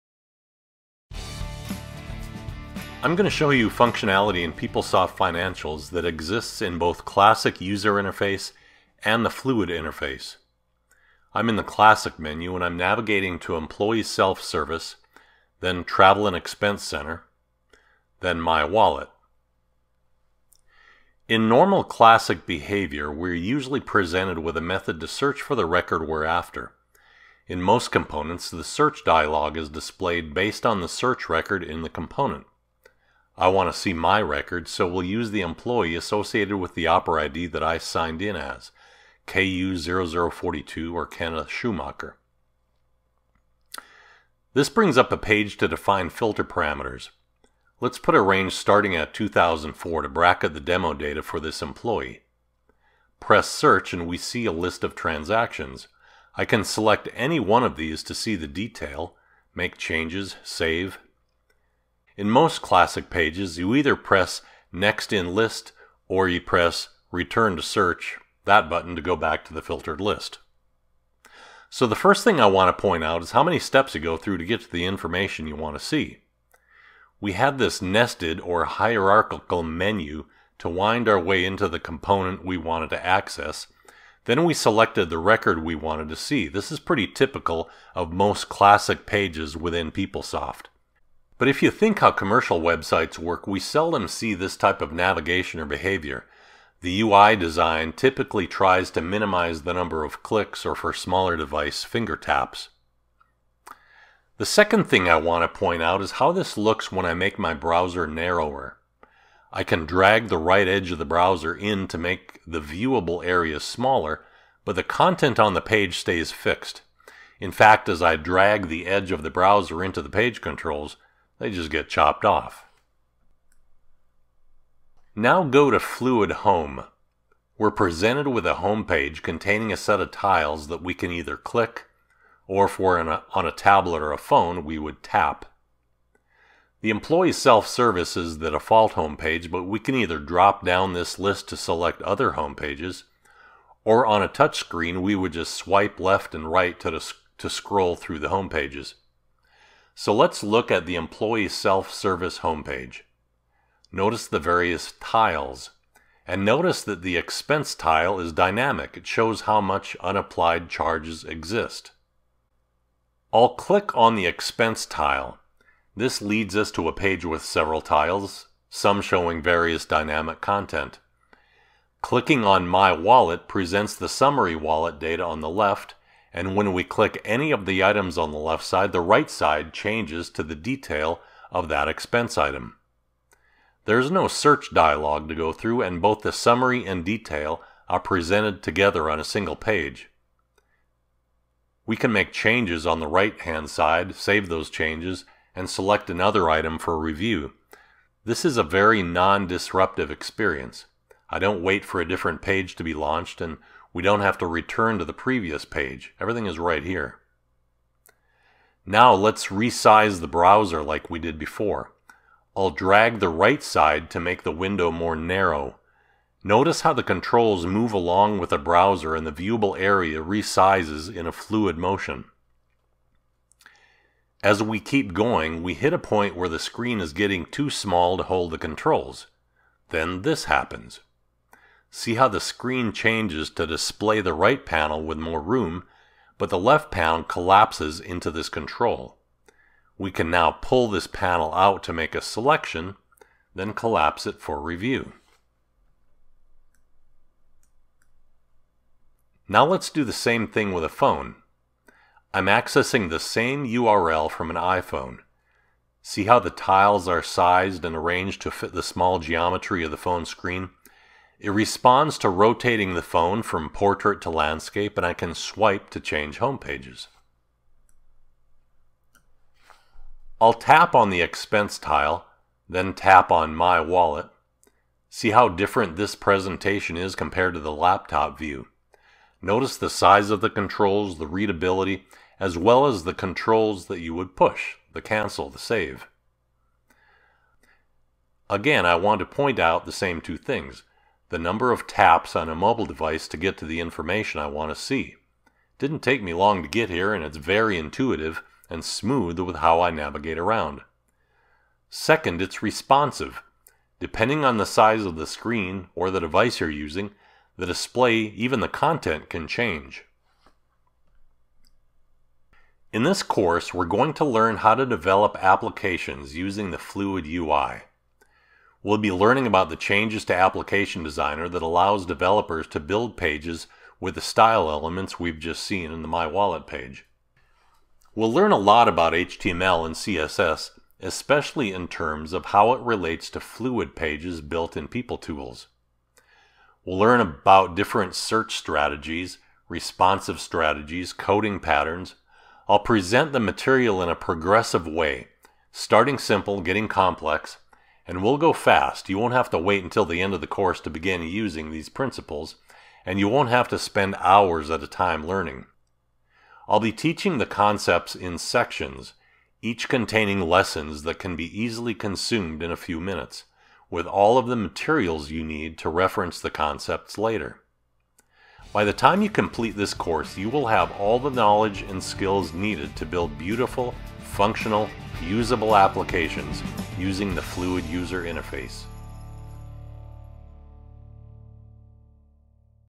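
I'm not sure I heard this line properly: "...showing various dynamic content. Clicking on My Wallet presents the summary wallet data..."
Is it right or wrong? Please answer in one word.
right.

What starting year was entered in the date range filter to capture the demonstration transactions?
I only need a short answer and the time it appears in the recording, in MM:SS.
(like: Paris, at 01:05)
2004, at 00:49.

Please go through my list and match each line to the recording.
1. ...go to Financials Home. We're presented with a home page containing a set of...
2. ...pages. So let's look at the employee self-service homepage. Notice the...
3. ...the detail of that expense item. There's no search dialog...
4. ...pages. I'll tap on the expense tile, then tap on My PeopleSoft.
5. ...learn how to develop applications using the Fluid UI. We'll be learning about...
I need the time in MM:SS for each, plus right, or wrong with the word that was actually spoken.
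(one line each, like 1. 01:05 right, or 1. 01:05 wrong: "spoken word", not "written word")
1. 02:05 wrong: "Fluid", not "Financials"
2. 02:28 right
3. 03:00 right
4. 04:26 wrong: "Wallet", not "PeopleSoft"
5. 05:14 right.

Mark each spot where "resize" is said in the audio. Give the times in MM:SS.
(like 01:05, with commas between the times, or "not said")
03:29, 03:40.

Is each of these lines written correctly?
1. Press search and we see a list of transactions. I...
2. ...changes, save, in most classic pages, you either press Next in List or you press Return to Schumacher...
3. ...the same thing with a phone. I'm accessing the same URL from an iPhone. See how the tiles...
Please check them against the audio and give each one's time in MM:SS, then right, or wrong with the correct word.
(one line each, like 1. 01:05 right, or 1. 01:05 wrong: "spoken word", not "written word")
1. 00:53 right
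2. 00:59 wrong: "Search", not "Schumacher"
3. 04:10 right.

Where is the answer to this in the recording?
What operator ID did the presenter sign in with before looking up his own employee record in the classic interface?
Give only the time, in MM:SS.
00:39.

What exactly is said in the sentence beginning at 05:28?
We'll learn a lot about HTML and CSS, especially in terms of how it relates to fluid pages built in PeopleTools.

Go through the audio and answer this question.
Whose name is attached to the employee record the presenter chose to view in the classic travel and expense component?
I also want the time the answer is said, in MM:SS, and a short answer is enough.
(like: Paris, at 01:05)
Kenneth Schumacher, at 00:41.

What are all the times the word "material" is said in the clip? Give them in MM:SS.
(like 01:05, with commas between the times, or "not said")
05:43, 06:04.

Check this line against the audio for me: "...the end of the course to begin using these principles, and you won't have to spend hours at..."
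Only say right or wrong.
right.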